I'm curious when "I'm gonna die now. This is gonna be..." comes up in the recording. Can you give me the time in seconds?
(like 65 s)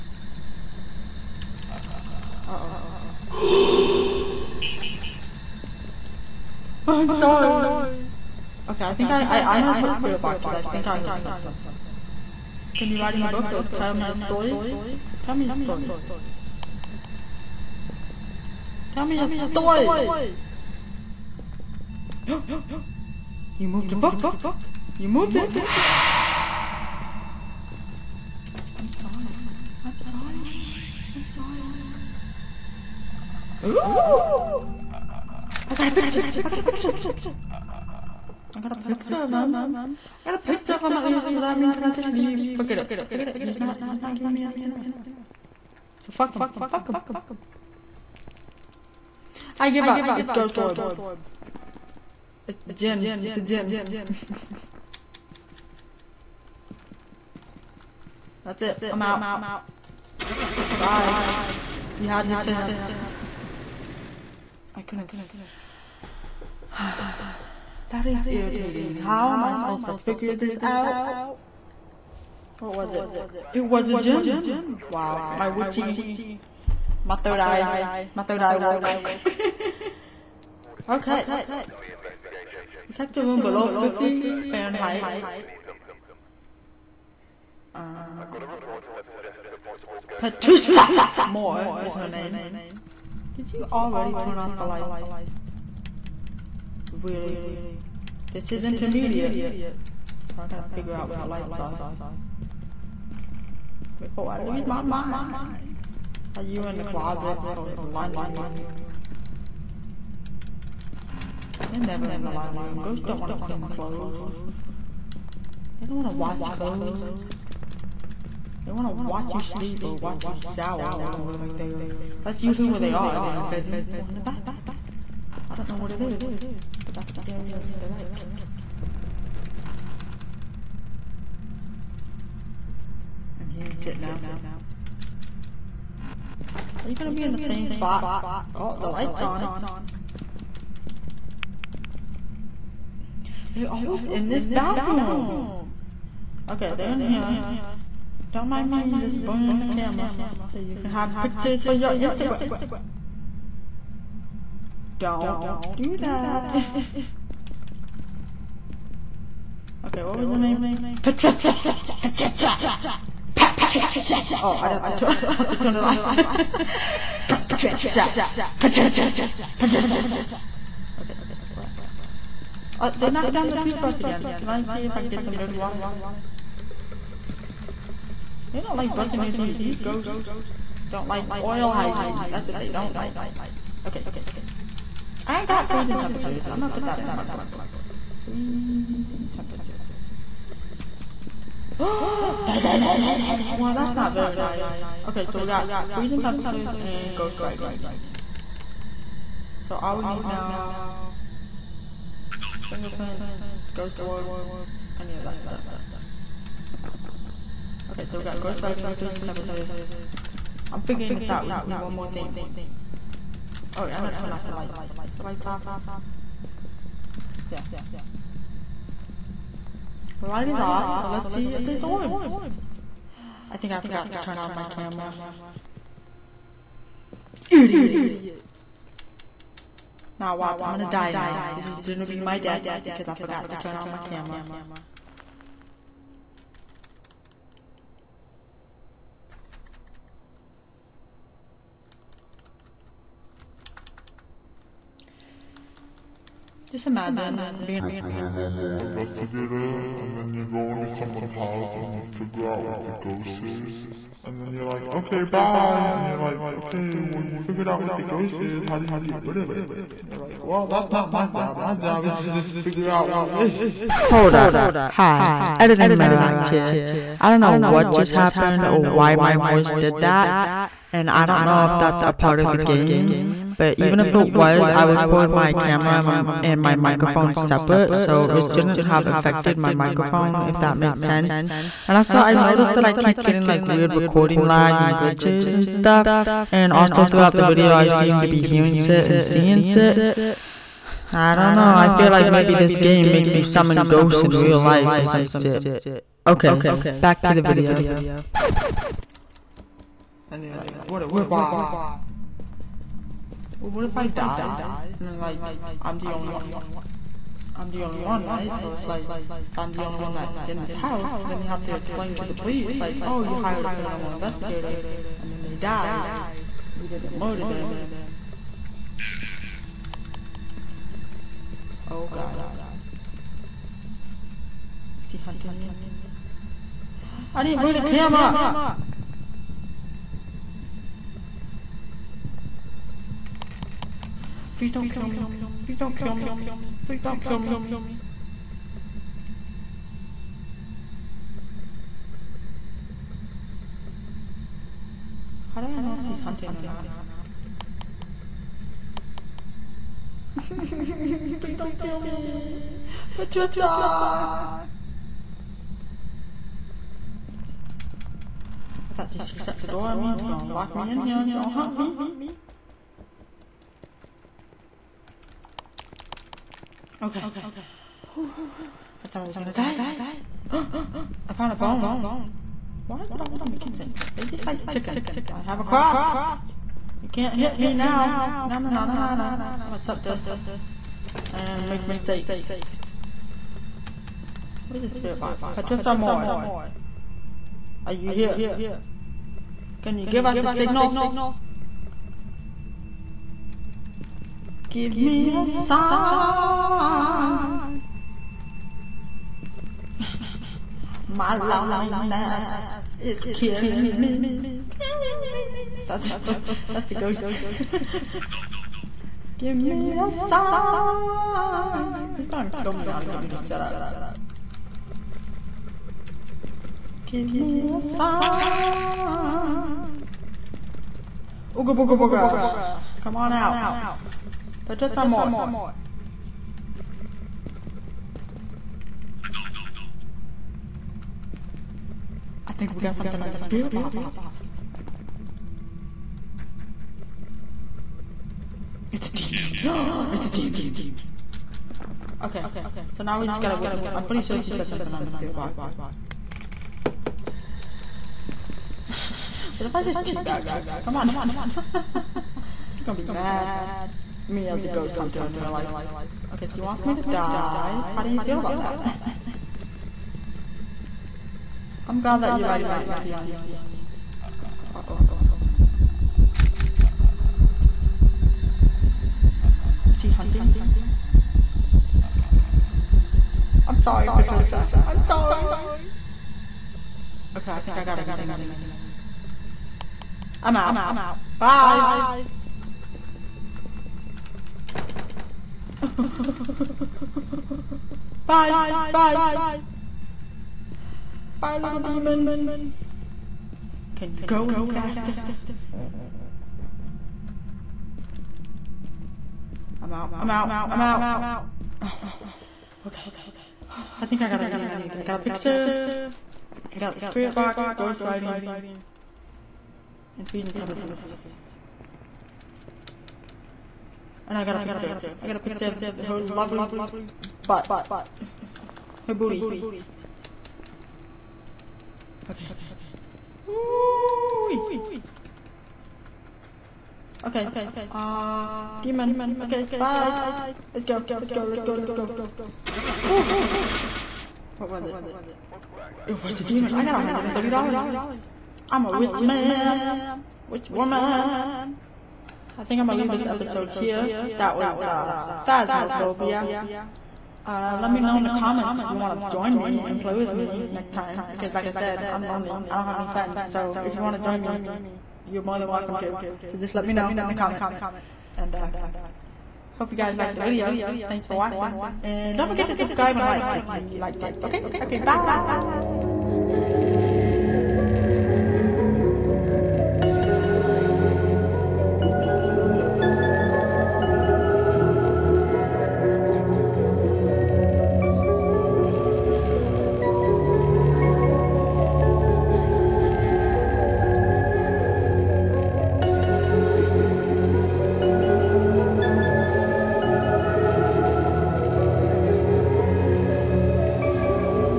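230 s.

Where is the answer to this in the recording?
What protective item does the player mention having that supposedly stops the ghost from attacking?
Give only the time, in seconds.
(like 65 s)
375 s.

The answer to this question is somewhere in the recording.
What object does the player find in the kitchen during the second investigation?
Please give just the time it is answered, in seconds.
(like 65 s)
371 s.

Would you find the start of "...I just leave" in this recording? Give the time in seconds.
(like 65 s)
41 s.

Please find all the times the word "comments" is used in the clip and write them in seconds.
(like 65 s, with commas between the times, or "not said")
548 s, 557 s.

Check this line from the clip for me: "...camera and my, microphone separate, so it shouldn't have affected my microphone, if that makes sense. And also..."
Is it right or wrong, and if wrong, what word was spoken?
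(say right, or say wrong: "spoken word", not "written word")
right.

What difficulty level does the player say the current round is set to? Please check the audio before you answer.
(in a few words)
Intermediate.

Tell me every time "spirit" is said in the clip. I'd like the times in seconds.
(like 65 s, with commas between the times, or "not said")
9 s, 384 s, 433 s, 445 s, 506 s.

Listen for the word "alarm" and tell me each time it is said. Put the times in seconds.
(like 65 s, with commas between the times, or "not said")
not said.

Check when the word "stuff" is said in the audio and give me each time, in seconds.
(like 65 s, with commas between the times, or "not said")
205 s, 285 s.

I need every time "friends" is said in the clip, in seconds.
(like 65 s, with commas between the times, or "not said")
553 s.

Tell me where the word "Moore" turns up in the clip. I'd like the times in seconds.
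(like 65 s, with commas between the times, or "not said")
91 s, 385 s.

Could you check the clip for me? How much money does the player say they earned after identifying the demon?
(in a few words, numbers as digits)
$130.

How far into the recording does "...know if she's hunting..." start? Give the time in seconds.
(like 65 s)
345 s.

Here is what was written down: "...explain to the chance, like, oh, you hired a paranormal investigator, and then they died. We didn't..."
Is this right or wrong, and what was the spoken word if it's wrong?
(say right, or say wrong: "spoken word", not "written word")
wrong: "police", not "chance".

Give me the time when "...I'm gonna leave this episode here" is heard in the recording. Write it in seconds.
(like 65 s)
542 s.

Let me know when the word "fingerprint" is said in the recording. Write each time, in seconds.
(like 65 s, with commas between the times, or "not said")
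202 s.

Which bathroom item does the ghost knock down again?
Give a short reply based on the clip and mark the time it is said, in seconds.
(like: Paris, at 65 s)
Toothbrush, at 173 s.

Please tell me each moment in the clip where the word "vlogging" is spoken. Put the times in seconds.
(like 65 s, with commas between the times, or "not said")
not said.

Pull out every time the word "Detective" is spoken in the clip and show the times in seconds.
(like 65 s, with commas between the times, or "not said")
82 s.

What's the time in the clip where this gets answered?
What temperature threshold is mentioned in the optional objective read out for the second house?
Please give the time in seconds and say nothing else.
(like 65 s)
83 s.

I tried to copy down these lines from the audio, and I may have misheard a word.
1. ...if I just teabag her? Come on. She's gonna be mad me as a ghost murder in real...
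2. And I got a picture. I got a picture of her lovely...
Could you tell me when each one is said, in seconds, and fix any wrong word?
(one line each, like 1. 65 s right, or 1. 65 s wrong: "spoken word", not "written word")
1. 449 s wrong: "hunter", not "murder"
2. 514 s right.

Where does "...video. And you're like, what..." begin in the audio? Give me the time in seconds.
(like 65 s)
297 s.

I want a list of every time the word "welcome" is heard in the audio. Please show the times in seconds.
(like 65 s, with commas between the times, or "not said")
555 s.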